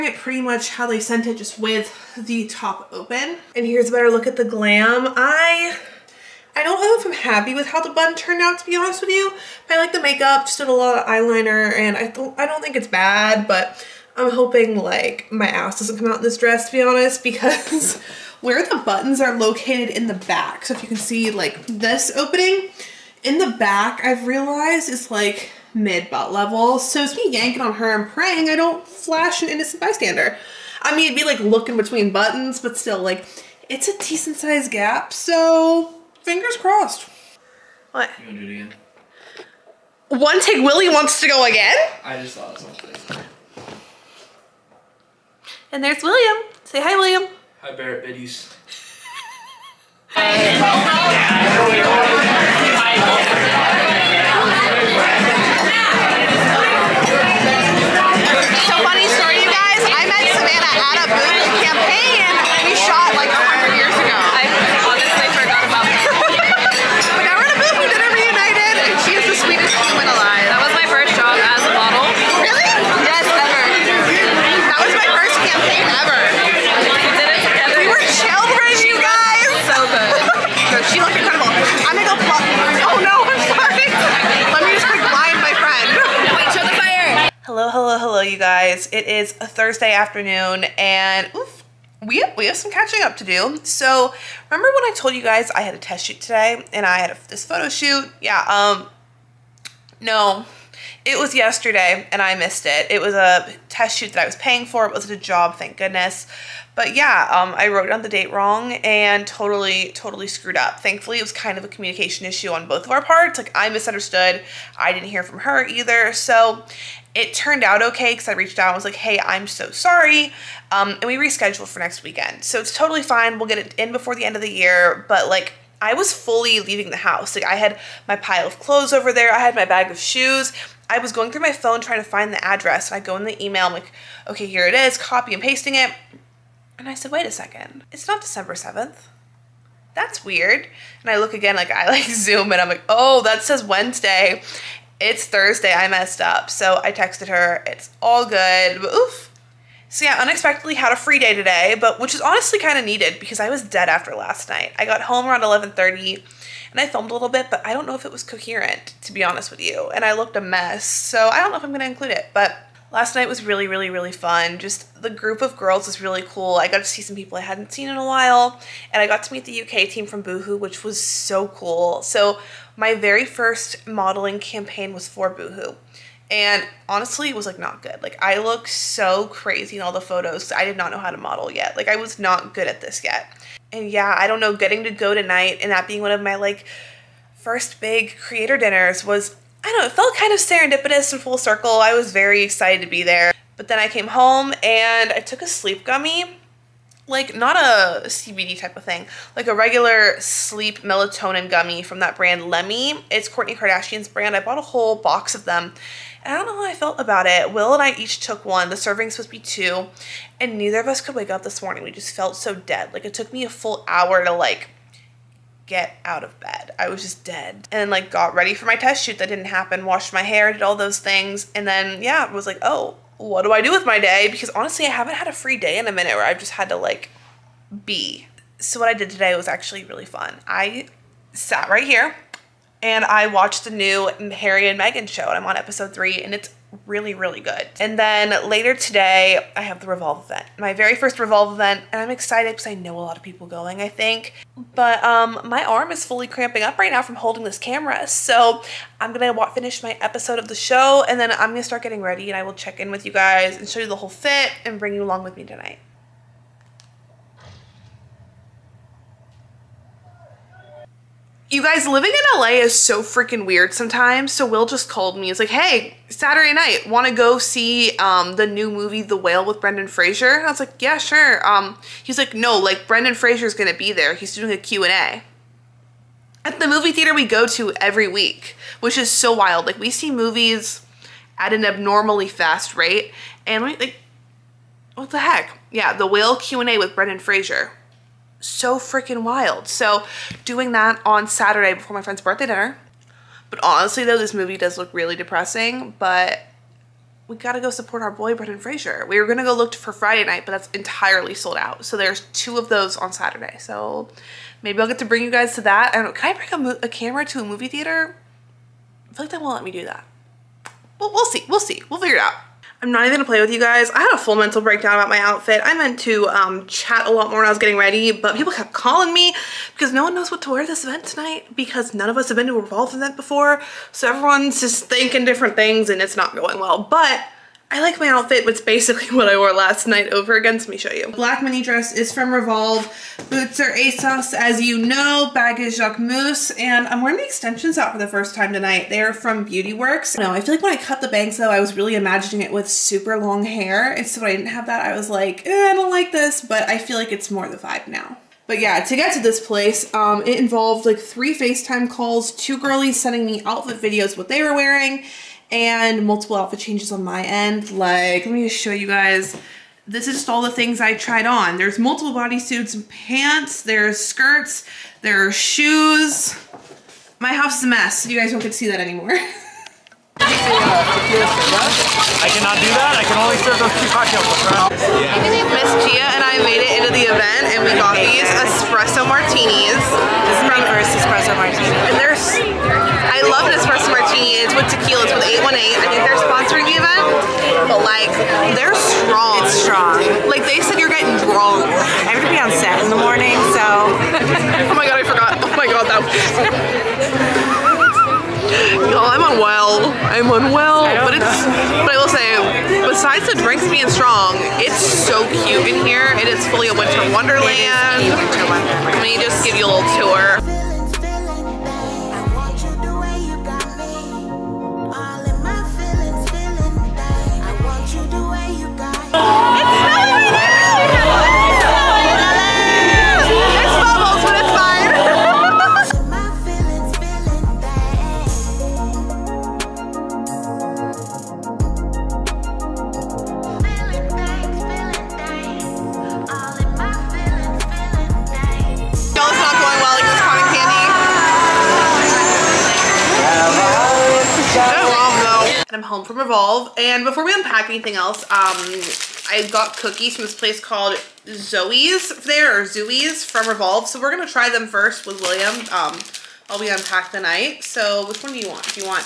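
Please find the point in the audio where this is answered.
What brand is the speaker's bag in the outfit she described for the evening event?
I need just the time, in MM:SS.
05:35.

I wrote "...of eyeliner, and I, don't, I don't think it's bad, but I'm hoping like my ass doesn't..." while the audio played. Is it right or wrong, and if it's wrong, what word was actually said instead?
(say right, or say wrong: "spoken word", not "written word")
right.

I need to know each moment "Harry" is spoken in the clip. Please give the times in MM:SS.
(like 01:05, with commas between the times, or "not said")
03:54.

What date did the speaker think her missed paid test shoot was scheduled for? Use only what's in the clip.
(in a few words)
December 7th.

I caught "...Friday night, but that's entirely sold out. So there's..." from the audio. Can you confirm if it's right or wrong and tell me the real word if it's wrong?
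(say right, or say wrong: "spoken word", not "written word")
right.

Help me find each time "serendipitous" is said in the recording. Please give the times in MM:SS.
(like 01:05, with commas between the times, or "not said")
03:10.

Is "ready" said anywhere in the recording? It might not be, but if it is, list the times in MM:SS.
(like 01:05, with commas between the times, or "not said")
03:38, 04:12, 05:17.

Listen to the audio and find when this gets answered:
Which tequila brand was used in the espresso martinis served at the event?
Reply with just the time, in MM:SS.
06:25.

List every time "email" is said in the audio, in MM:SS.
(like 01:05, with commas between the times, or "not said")
02:13.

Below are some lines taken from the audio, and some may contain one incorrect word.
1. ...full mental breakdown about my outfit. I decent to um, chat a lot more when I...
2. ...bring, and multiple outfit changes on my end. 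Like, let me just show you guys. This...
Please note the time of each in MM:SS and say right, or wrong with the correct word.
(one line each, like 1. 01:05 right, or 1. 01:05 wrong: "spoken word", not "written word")
1. 05:14 wrong: "meant", not "decent"
2. 05:54 wrong: "wearing", not "bring".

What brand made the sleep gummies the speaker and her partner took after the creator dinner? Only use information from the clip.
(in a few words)
Lemme.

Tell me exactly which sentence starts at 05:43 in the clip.
And so when I didn't have that, I was like, eh, I don't like this.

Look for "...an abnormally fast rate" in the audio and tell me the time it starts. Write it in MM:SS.
04:41.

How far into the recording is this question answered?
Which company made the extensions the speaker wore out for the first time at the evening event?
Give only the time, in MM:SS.
05:39.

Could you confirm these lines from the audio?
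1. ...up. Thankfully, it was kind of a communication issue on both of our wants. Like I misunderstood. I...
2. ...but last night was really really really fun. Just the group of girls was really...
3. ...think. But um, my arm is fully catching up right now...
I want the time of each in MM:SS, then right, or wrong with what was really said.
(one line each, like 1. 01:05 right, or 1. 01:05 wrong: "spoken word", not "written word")
1. 01:50 wrong: "parts", not "wants"
2. 02:42 right
3. 04:03 wrong: "cramping", not "catching".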